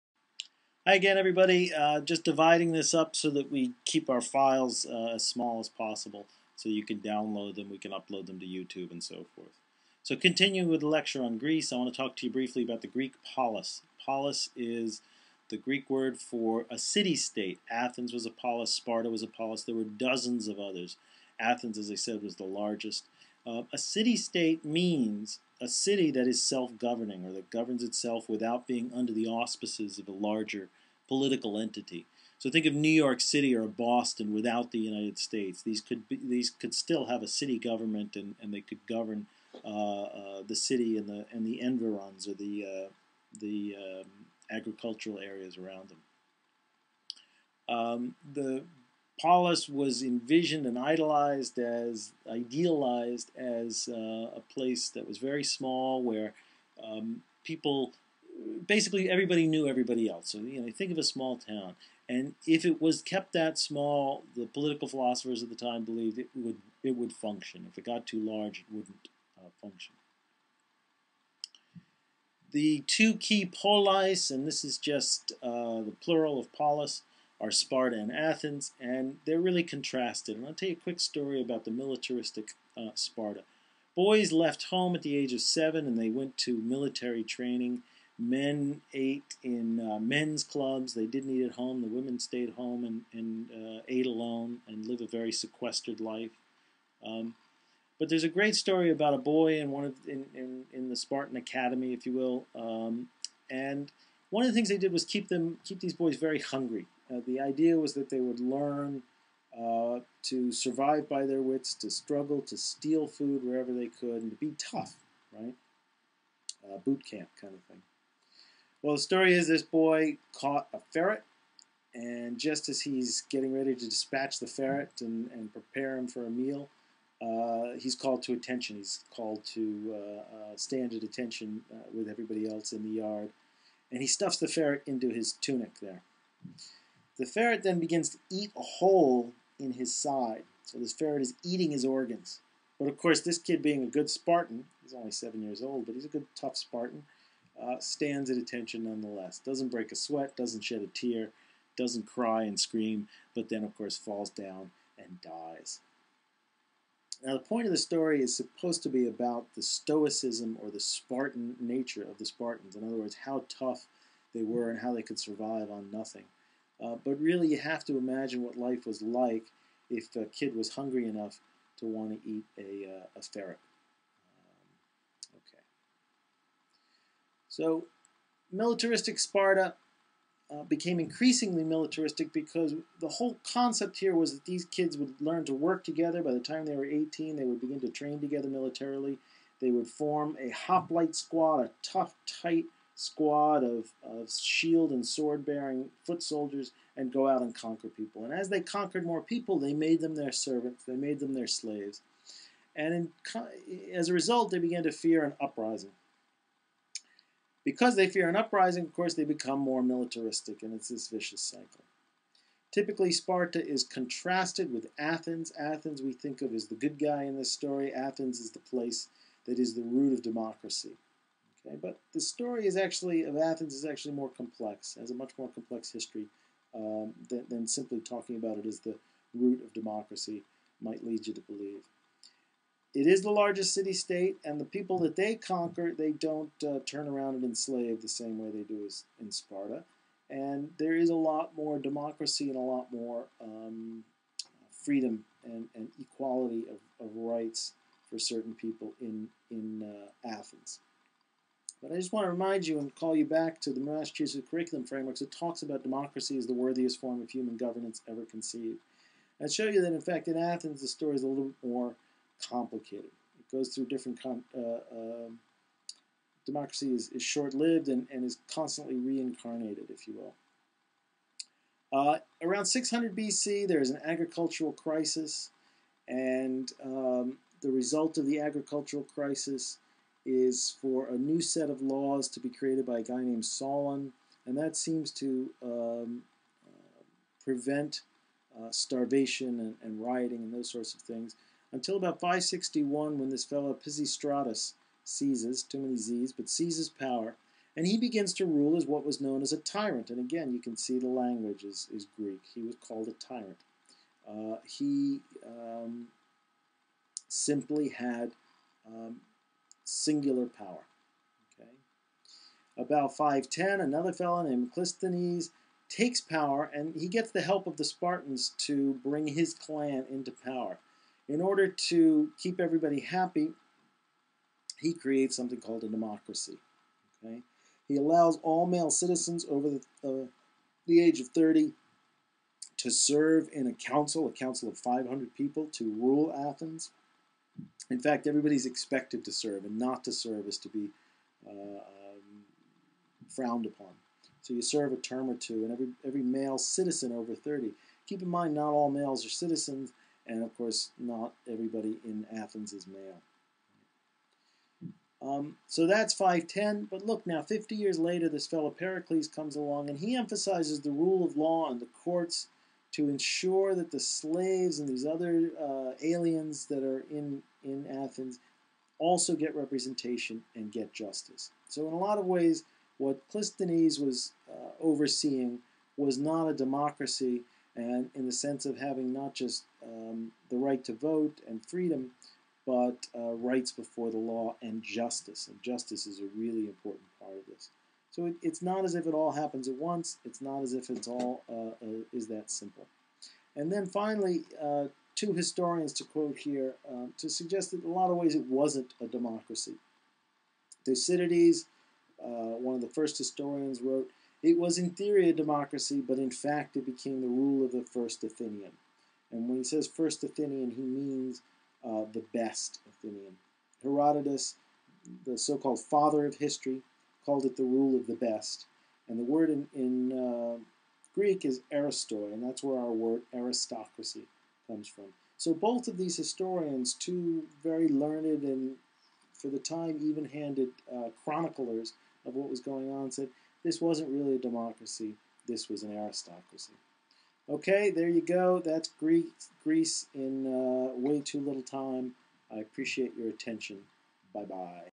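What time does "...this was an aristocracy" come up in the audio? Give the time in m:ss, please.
7:15.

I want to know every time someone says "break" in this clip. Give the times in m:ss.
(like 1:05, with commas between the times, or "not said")
2:29.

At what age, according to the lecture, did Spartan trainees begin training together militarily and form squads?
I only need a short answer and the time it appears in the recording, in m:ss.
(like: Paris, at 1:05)
18, at 3:06.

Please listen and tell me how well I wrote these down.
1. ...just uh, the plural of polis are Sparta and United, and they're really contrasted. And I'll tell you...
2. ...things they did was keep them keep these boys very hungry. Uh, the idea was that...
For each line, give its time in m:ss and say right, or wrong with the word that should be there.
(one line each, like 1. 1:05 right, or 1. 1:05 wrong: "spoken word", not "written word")
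1. 1:14 wrong: "Athens", not "United"
2. 1:44 right.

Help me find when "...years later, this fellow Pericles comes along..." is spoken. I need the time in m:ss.
5:57.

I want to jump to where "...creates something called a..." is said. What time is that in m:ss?
5:24.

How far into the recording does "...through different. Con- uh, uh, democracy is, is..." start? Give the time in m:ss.
4:23.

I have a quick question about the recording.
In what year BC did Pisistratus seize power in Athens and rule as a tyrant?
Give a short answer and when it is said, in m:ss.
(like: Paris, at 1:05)
561, at 4:52.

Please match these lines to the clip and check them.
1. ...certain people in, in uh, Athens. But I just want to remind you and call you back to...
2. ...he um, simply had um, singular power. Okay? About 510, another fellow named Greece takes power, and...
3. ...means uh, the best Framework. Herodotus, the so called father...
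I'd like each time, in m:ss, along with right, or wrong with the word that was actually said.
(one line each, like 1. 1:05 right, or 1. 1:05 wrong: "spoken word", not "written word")
1. 4:08 right
2. 5:04 wrong: "Clisthenes", not "Greece"
3. 6:50 wrong: "Athenian", not "Framework".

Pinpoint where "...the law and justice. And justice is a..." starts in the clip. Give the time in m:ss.
6:24.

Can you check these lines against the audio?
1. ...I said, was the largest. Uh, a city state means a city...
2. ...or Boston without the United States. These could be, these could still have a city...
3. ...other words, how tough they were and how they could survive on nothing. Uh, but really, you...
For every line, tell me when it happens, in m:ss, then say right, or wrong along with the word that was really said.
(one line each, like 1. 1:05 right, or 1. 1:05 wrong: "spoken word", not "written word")
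1. 0:21 right
2. 0:33 right
3. 2:42 right.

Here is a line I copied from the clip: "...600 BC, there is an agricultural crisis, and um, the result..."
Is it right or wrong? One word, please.
right.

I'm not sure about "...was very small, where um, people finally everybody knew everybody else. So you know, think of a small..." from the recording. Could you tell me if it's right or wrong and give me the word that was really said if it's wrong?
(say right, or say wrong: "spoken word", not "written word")
wrong: "basically", not "finally".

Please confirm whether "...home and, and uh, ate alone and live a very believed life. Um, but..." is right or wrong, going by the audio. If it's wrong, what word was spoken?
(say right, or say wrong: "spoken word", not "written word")
wrong: "sequestered", not "believed".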